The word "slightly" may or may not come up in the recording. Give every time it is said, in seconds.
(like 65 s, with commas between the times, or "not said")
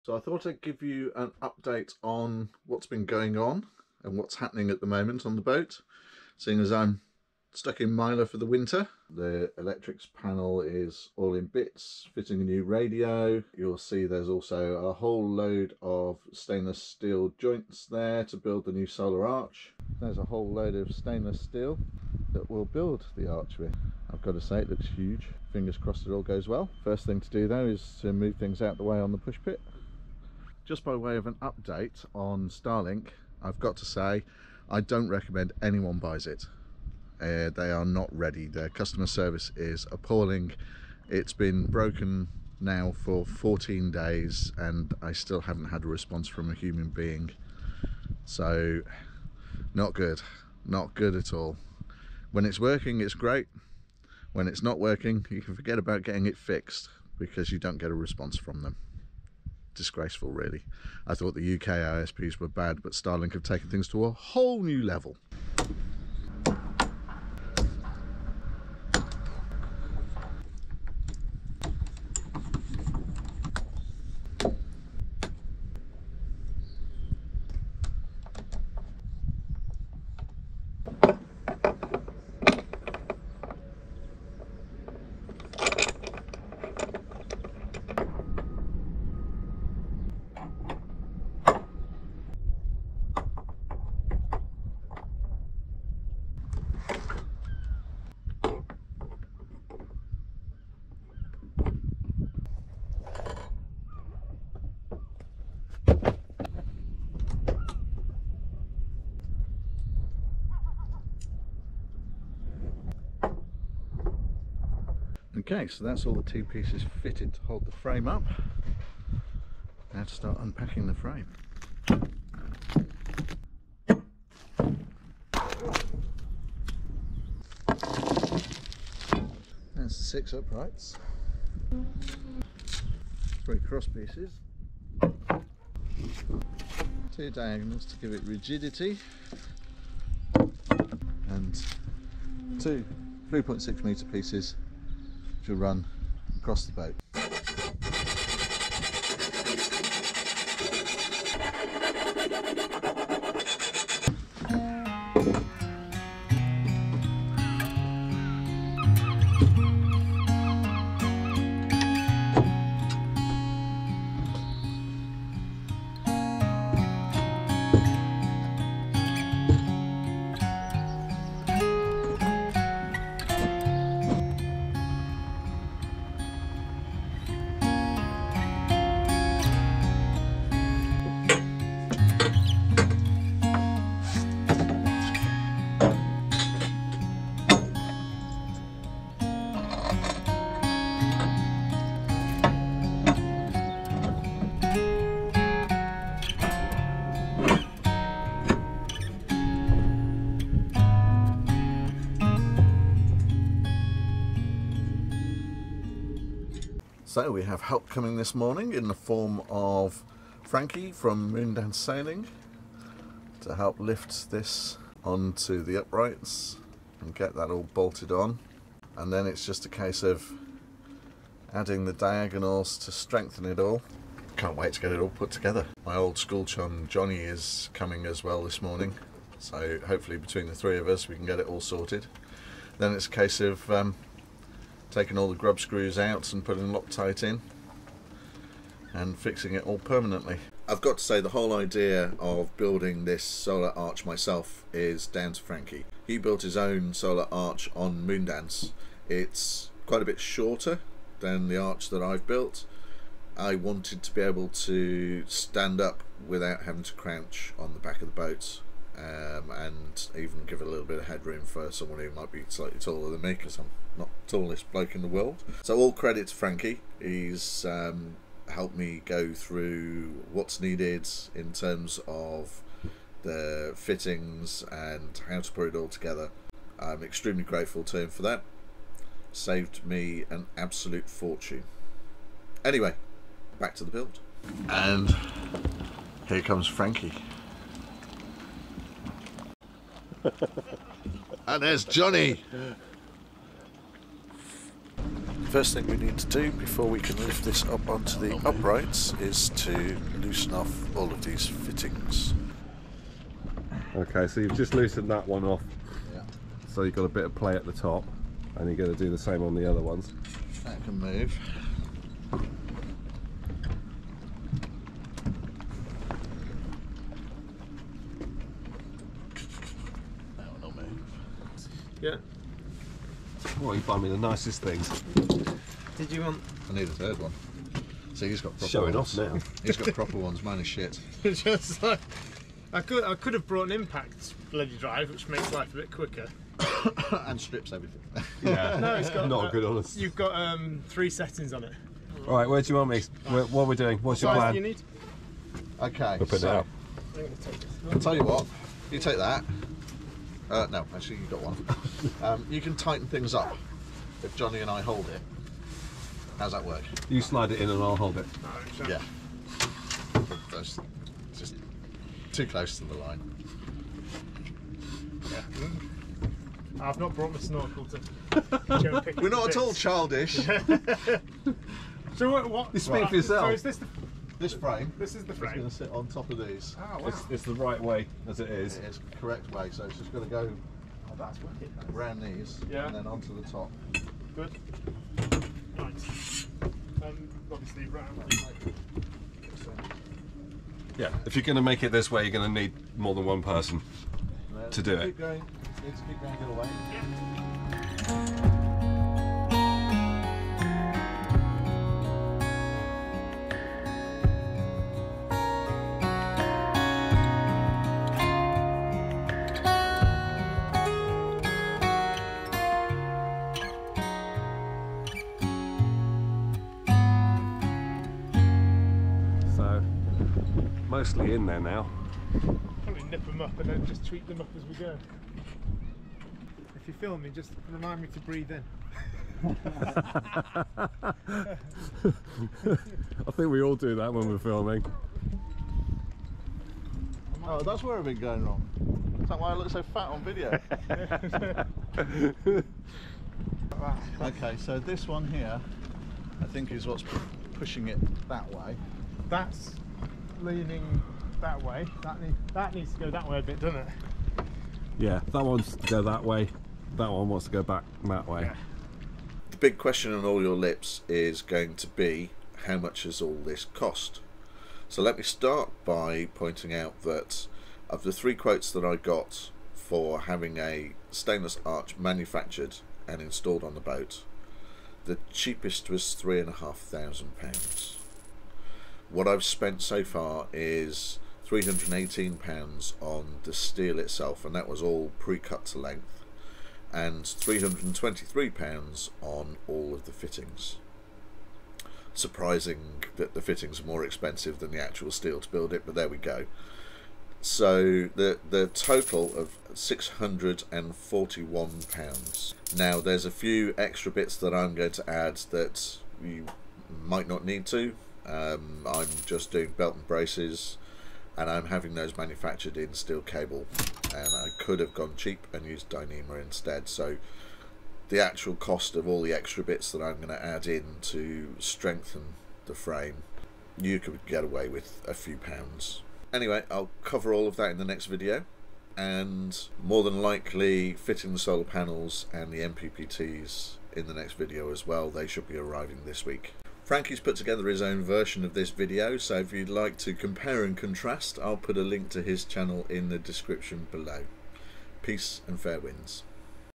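262 s.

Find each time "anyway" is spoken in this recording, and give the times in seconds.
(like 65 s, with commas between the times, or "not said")
282 s, 526 s.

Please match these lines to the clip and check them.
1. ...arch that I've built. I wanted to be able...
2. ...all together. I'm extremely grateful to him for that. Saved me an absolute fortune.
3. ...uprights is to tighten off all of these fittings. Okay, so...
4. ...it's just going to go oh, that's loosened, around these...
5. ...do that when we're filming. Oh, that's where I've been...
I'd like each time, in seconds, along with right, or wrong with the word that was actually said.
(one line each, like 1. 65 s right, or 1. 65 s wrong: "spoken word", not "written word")
1. 251 s right
2. 275 s right
3. 298 s wrong: "loosen", not "tighten"
4. 379 s wrong: "wicked", not "loosened"
5. 433 s right.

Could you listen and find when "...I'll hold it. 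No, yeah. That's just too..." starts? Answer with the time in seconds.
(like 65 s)
357 s.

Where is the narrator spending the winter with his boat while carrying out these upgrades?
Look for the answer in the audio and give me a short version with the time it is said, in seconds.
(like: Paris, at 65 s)
Milo, at 7 s.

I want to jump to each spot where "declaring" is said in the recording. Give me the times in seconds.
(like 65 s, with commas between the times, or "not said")
not said.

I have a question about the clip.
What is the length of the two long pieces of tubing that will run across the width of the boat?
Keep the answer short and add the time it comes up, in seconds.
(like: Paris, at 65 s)
3.6 metres, at 143 s.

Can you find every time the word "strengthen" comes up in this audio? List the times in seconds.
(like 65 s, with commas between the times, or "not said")
222 s, 521 s.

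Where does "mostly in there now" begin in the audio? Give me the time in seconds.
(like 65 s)
421 s.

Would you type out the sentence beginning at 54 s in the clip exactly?
When it's not working, you can forget about getting it fixed because you don't get a response from them disgraceful, really.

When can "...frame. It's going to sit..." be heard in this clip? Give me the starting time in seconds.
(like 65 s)
375 s.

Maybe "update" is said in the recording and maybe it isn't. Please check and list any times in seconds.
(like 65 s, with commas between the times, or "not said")
1 s, 31 s.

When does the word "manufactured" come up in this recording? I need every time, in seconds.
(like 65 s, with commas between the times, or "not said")
471 s, 512 s.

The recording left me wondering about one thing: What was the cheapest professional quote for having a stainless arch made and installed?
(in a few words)
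£3,500.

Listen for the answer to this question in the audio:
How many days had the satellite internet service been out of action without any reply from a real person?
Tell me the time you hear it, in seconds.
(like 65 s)
43 s.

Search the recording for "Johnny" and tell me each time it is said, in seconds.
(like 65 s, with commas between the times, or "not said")
226 s, 291 s, 354 s.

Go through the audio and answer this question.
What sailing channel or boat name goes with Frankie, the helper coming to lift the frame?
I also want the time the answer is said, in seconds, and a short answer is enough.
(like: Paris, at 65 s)
Moondance Sailing, at 211 s.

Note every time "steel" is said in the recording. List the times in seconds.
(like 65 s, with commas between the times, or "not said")
16 s, 21 s, 483 s, 495 s, 512 s.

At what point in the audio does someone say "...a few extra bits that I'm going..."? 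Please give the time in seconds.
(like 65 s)
503 s.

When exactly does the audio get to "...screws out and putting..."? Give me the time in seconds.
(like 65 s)
235 s.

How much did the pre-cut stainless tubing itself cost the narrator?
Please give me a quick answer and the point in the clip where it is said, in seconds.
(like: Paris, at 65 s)
£318, at 481 s.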